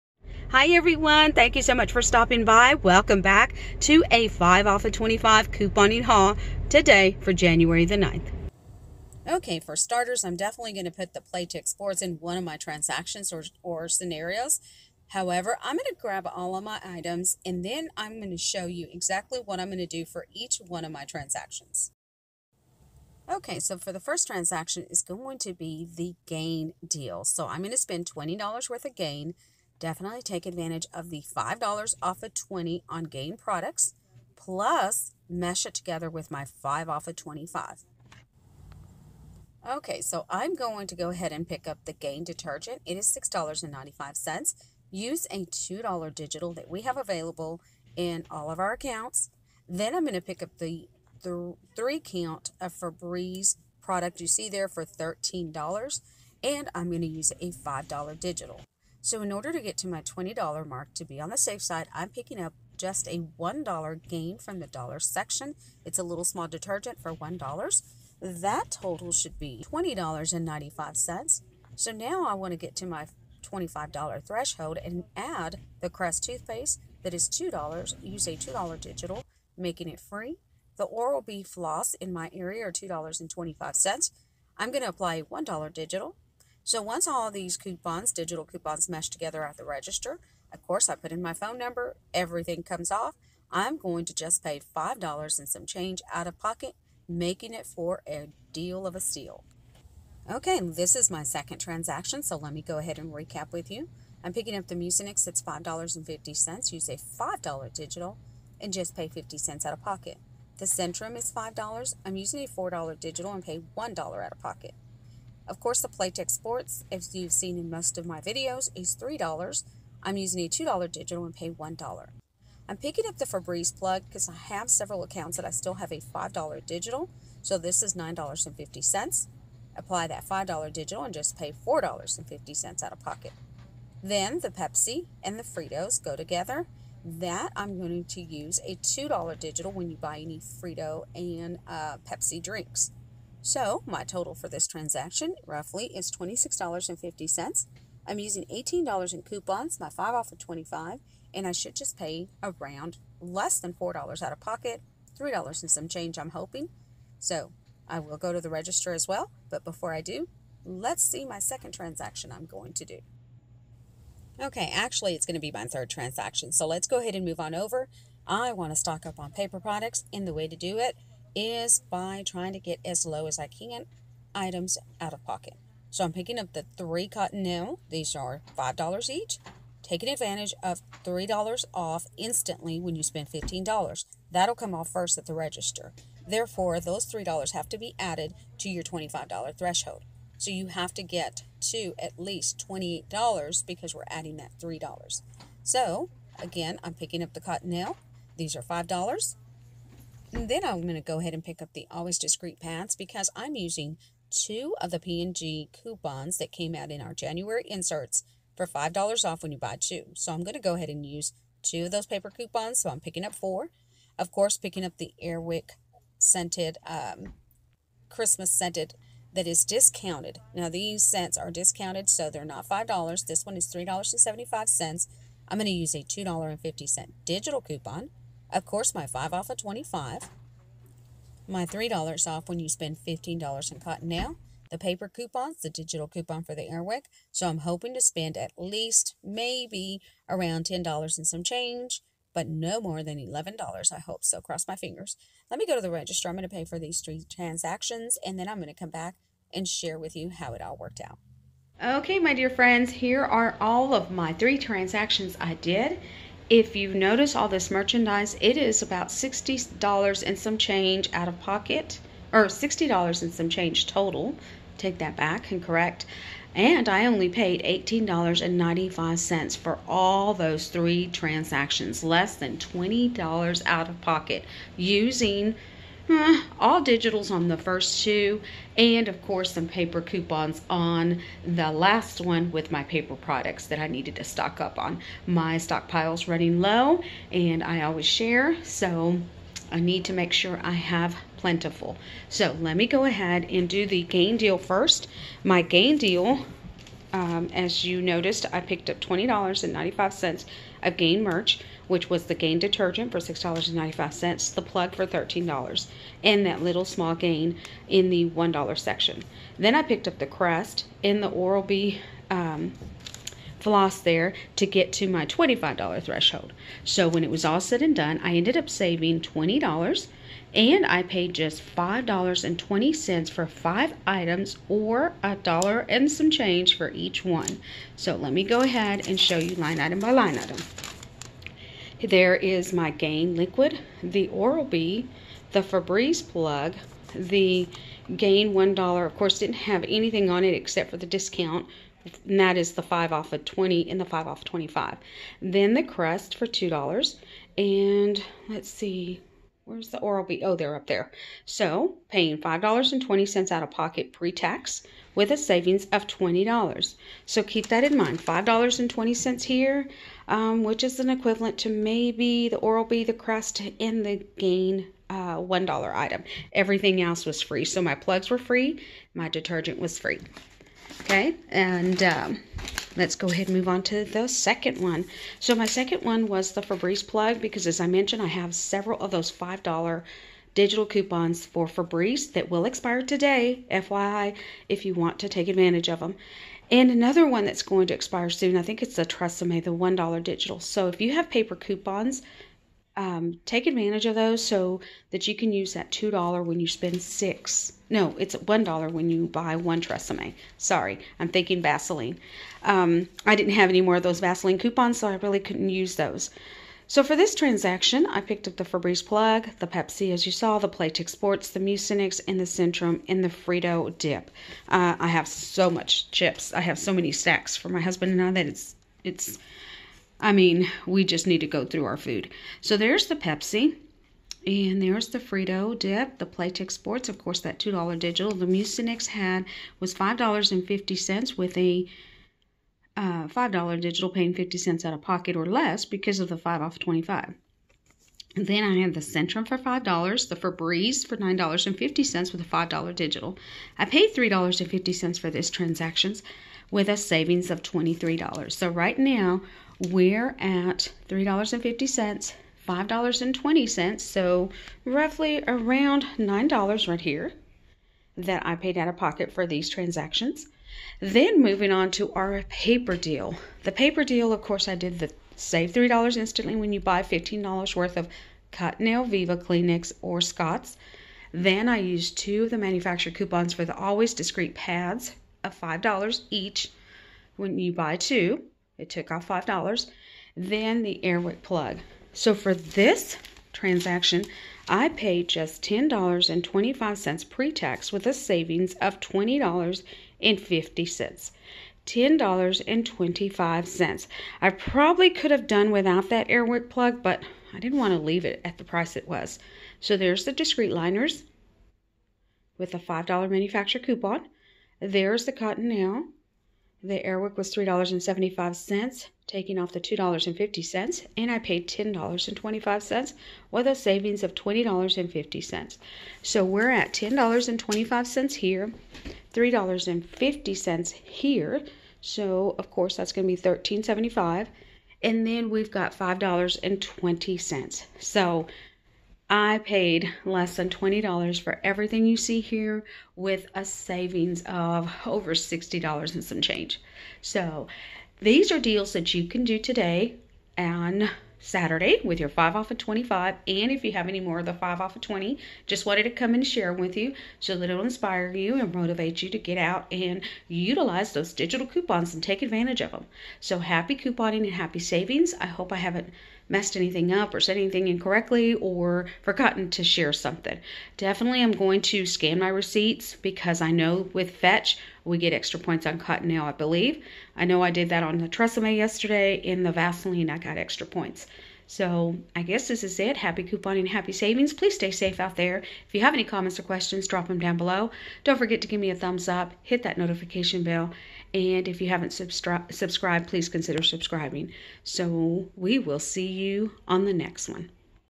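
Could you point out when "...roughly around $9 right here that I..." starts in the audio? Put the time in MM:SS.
07:34.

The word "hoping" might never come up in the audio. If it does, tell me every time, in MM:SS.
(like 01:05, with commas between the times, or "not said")
02:36, 03:57.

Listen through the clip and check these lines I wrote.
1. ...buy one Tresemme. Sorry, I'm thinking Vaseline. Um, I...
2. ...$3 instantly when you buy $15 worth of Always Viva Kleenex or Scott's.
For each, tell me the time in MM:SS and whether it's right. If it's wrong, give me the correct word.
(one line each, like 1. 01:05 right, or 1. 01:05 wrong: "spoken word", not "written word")
1. 06:39 right
2. 07:45 wrong: "Cottonelle", not "Always".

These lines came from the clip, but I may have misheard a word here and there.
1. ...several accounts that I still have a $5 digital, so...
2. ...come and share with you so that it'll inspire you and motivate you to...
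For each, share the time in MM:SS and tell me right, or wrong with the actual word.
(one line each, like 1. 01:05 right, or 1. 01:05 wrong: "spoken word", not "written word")
1. 02:04 right
2. 09:06 right.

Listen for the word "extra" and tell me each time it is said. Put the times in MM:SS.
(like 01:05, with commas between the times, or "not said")
09:25, 09:30.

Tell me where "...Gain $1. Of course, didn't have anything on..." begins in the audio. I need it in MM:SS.
05:38.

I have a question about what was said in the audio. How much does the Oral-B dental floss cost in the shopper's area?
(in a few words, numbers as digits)
$2.25.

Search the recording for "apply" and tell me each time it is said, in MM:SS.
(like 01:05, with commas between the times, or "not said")
01:24, 02:09.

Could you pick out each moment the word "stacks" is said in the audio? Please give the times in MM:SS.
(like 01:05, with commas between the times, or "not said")
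06:57.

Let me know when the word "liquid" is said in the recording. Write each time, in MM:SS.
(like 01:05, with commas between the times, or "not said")
05:33.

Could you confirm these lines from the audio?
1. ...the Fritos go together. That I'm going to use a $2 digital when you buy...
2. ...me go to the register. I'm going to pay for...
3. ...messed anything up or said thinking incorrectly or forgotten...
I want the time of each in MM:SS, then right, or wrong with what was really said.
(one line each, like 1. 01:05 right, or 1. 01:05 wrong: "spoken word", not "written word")
1. 02:15 right
2. 04:05 right
3. 09:16 wrong: "anything", not "thinking".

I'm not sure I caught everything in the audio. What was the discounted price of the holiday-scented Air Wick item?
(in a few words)
$3.75.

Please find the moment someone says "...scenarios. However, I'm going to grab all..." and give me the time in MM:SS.
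00:13.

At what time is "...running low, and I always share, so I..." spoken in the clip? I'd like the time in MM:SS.
04:46.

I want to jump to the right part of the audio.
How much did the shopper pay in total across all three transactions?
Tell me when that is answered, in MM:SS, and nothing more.
04:27.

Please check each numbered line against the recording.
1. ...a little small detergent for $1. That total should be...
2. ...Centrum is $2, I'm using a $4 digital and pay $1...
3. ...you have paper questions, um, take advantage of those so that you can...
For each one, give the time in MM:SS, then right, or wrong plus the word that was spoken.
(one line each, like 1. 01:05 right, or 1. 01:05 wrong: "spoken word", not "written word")
1. 01:05 right
2. 01:50 wrong: "5", not "2"
3. 06:31 wrong: "coupons", not "questions".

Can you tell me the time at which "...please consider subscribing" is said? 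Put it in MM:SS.
09:43.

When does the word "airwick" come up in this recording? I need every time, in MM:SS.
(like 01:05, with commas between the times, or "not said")
03:35, 03:56, 08:01, 08:16.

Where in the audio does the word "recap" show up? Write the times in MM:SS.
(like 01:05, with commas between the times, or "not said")
01:43.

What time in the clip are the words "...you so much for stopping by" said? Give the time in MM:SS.
00:01.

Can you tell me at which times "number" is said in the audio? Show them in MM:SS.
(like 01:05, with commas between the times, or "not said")
01:31.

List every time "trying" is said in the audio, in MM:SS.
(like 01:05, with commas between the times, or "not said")
02:52.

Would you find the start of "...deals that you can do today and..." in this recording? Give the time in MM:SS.
08:58.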